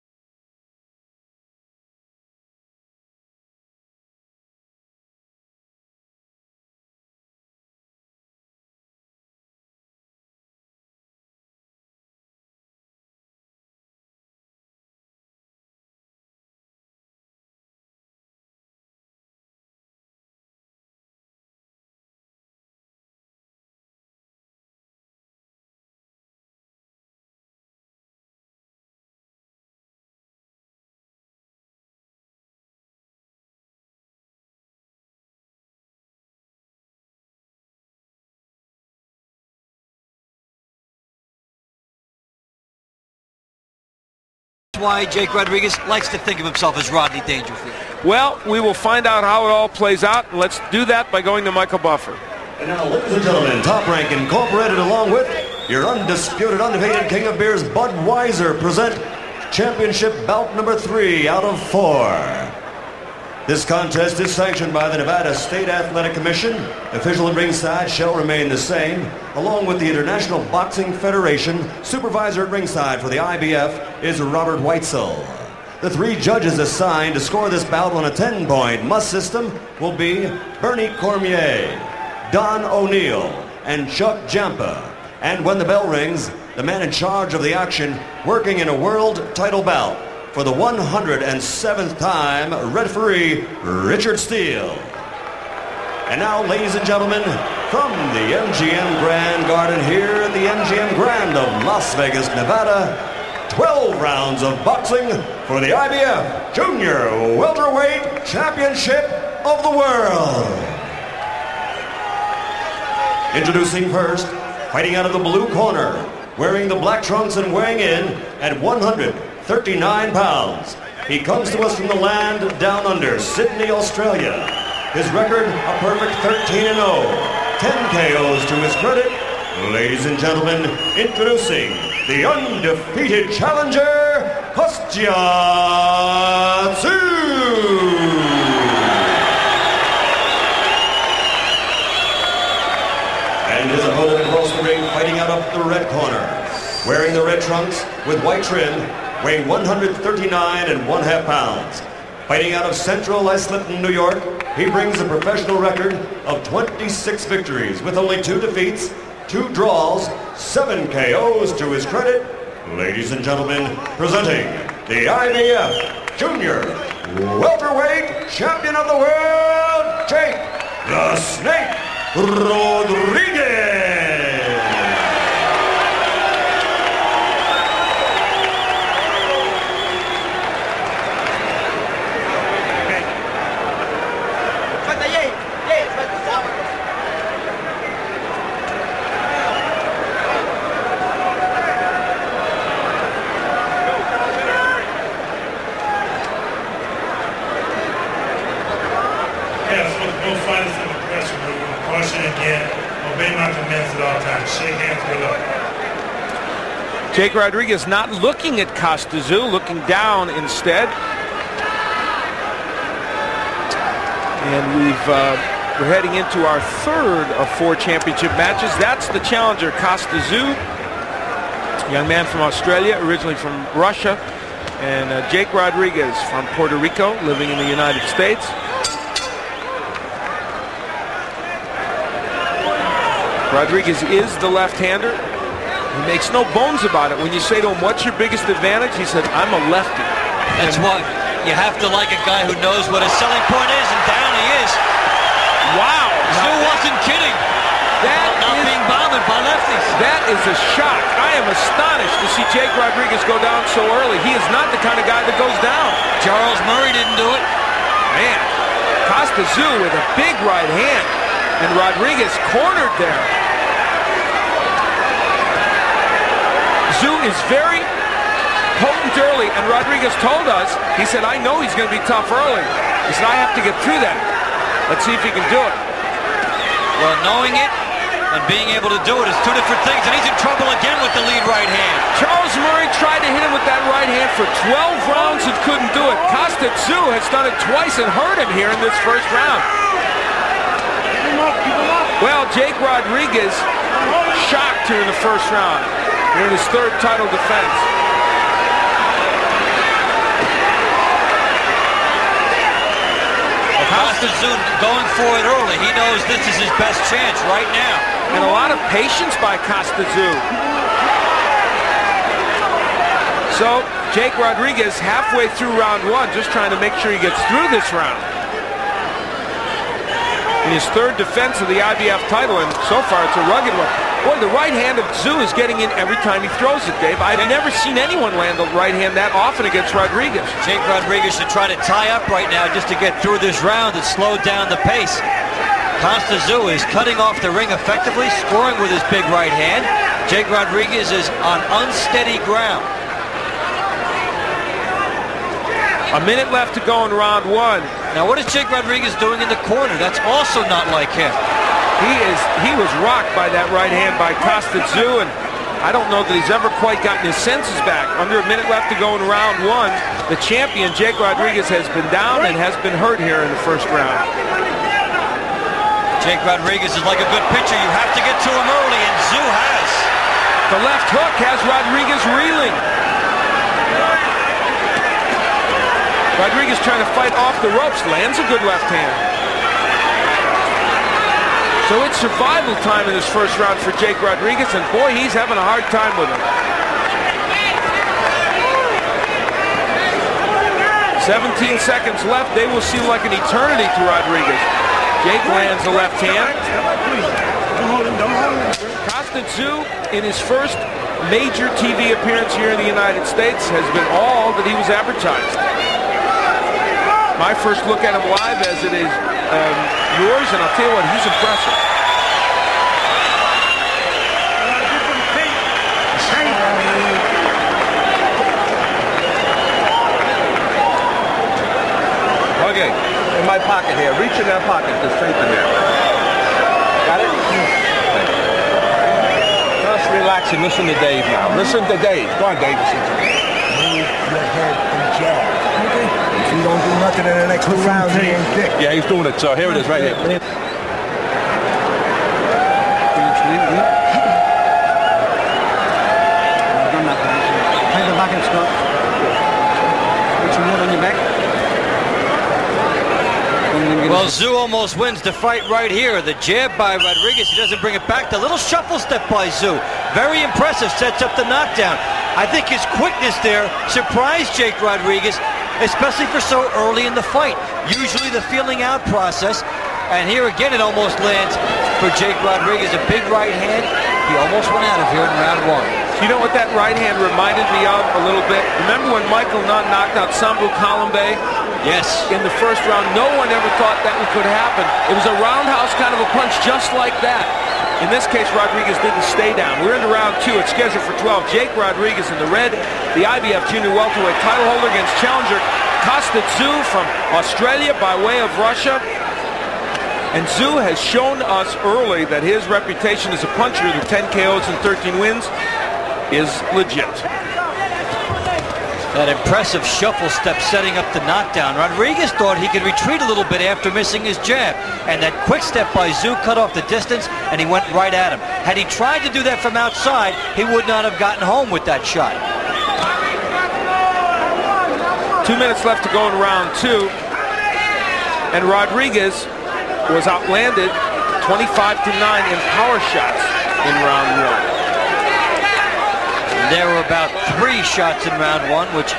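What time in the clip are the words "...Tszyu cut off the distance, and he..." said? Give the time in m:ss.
8:36.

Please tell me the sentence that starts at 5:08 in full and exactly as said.
And a lot of patience by Costazun.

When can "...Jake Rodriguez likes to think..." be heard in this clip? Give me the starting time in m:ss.
0:45.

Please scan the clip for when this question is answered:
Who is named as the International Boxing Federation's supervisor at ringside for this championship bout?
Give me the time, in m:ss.
1:14.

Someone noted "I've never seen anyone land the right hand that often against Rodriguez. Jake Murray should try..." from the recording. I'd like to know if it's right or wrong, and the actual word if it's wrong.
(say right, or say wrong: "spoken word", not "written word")
wrong: "Rodriguez", not "Murray".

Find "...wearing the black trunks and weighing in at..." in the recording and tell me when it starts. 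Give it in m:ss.
1:56.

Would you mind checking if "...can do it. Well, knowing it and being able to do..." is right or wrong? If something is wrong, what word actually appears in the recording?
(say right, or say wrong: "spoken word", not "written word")
right.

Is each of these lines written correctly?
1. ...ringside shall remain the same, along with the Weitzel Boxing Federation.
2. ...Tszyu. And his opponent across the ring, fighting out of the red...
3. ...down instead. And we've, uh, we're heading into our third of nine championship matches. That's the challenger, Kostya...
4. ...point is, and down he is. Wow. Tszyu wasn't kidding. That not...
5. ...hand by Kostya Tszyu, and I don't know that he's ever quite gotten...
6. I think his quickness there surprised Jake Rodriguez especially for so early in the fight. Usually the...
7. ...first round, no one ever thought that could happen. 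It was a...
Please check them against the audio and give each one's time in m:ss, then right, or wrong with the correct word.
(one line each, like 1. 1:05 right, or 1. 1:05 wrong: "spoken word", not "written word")
1. 1:07 wrong: "International", not "Weitzel"
2. 2:16 right
3. 3:29 wrong: "four", not "nine"
4. 4:03 right
5. 5:53 right
6. 7:42 right
7. 8:02 right.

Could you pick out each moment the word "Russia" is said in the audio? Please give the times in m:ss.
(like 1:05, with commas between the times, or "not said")
3:43, 8:18.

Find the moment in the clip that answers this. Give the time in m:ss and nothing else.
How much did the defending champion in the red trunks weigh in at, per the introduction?
2:29.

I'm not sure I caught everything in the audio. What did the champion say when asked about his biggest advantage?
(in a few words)
I'm a lefty.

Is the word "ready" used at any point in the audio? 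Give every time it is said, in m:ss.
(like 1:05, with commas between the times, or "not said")
not said.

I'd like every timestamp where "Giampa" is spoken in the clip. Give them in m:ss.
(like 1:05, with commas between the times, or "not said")
1:24.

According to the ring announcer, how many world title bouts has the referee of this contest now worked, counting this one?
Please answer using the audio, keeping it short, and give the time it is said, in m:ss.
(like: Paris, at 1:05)
107, at 1:30.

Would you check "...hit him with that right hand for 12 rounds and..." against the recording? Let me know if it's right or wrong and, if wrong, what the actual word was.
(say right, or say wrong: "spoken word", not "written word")
right.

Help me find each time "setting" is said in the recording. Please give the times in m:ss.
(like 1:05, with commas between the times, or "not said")
8:30.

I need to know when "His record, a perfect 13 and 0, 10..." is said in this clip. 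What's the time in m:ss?
2:04.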